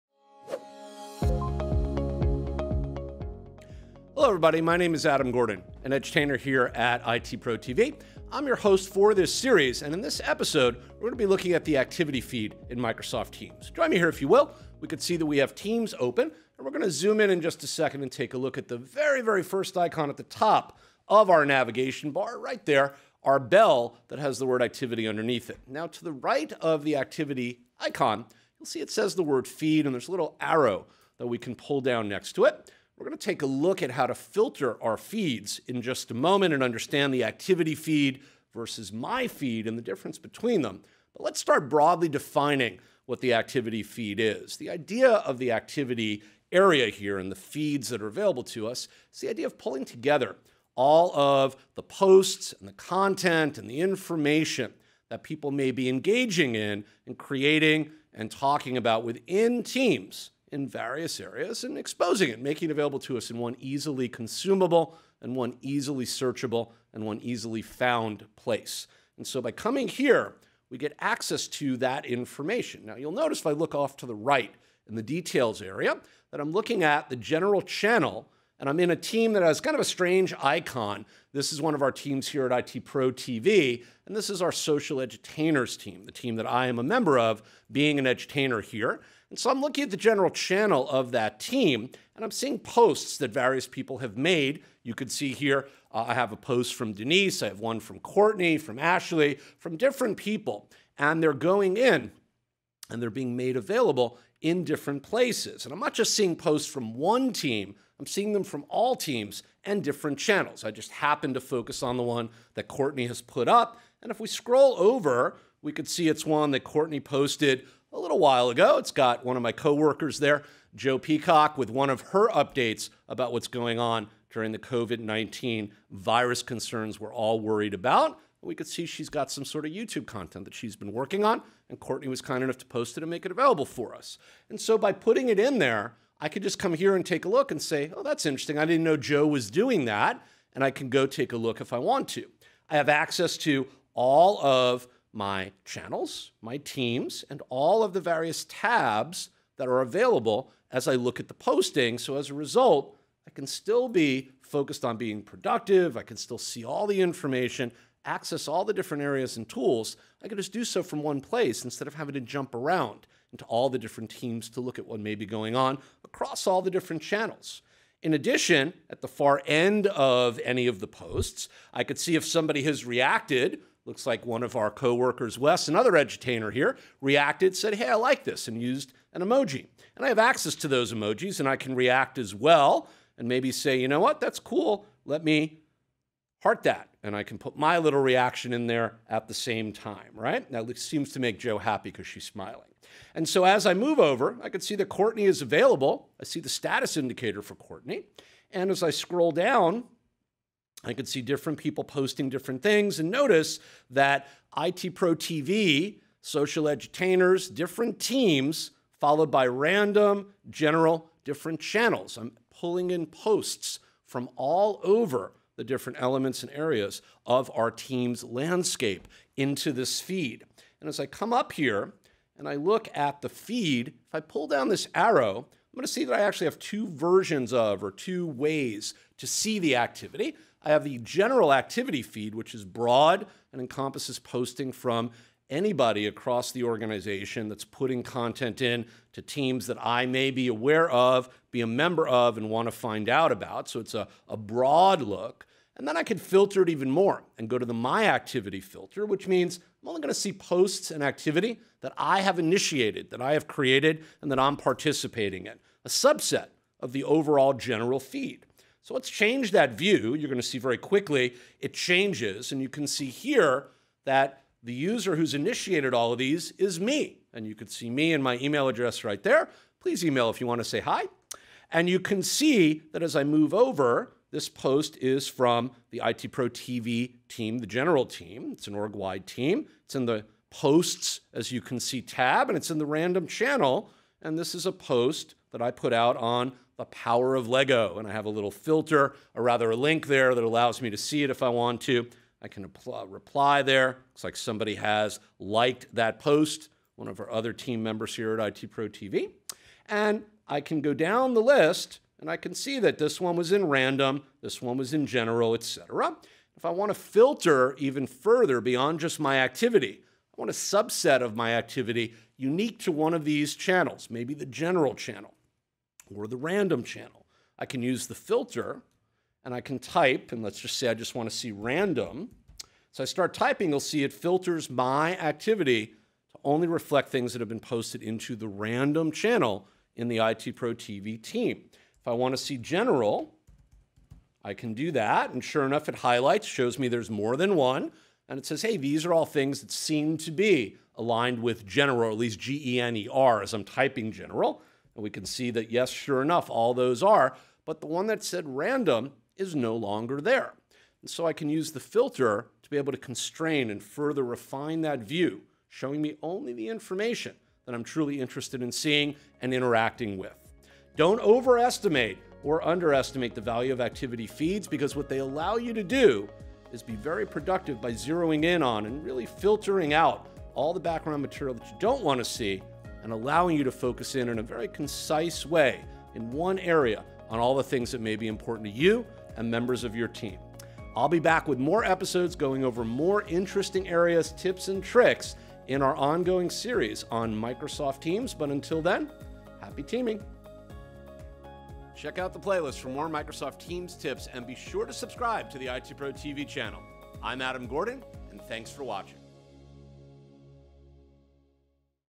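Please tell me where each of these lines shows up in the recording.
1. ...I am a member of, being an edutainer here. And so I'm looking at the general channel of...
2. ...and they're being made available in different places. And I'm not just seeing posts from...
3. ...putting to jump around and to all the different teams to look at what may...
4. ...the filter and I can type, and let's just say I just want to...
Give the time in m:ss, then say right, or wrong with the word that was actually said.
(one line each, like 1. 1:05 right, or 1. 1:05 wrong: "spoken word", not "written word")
1. 1:26 right
2. 1:42 right
3. 2:41 wrong: "having", not "putting"
4. 5:18 right.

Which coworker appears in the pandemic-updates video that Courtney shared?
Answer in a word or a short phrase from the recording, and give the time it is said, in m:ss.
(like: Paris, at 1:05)
Joe Peacock, at 2:00.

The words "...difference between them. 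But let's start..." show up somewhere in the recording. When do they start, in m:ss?
0:39.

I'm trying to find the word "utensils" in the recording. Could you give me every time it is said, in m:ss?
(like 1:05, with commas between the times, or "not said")
not said.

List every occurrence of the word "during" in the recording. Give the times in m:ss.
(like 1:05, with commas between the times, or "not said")
2:04.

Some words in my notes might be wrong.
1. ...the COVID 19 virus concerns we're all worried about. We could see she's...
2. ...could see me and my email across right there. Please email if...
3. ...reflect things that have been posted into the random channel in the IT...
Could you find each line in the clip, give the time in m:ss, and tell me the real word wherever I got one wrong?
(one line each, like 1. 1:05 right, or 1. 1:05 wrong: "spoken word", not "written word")
1. 2:04 right
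2. 4:27 wrong: "address", not "across"
3. 5:26 right.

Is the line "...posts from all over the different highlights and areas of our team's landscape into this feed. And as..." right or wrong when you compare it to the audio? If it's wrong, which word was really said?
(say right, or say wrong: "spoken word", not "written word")
wrong: "elements", not "highlights".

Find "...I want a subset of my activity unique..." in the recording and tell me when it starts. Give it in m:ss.
5:10.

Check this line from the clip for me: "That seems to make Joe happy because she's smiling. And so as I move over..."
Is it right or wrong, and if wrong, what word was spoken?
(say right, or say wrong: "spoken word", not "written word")
right.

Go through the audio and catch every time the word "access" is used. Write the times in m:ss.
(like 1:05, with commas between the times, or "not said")
1:10, 2:22, 2:38, 3:00.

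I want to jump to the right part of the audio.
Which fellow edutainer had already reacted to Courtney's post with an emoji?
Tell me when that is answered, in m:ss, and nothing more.
2:55.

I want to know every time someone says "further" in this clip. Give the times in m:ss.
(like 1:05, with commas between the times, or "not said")
5:08, 5:53.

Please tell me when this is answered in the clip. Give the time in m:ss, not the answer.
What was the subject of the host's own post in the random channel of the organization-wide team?
4:46.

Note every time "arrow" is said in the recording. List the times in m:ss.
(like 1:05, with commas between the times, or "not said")
0:30, 3:44.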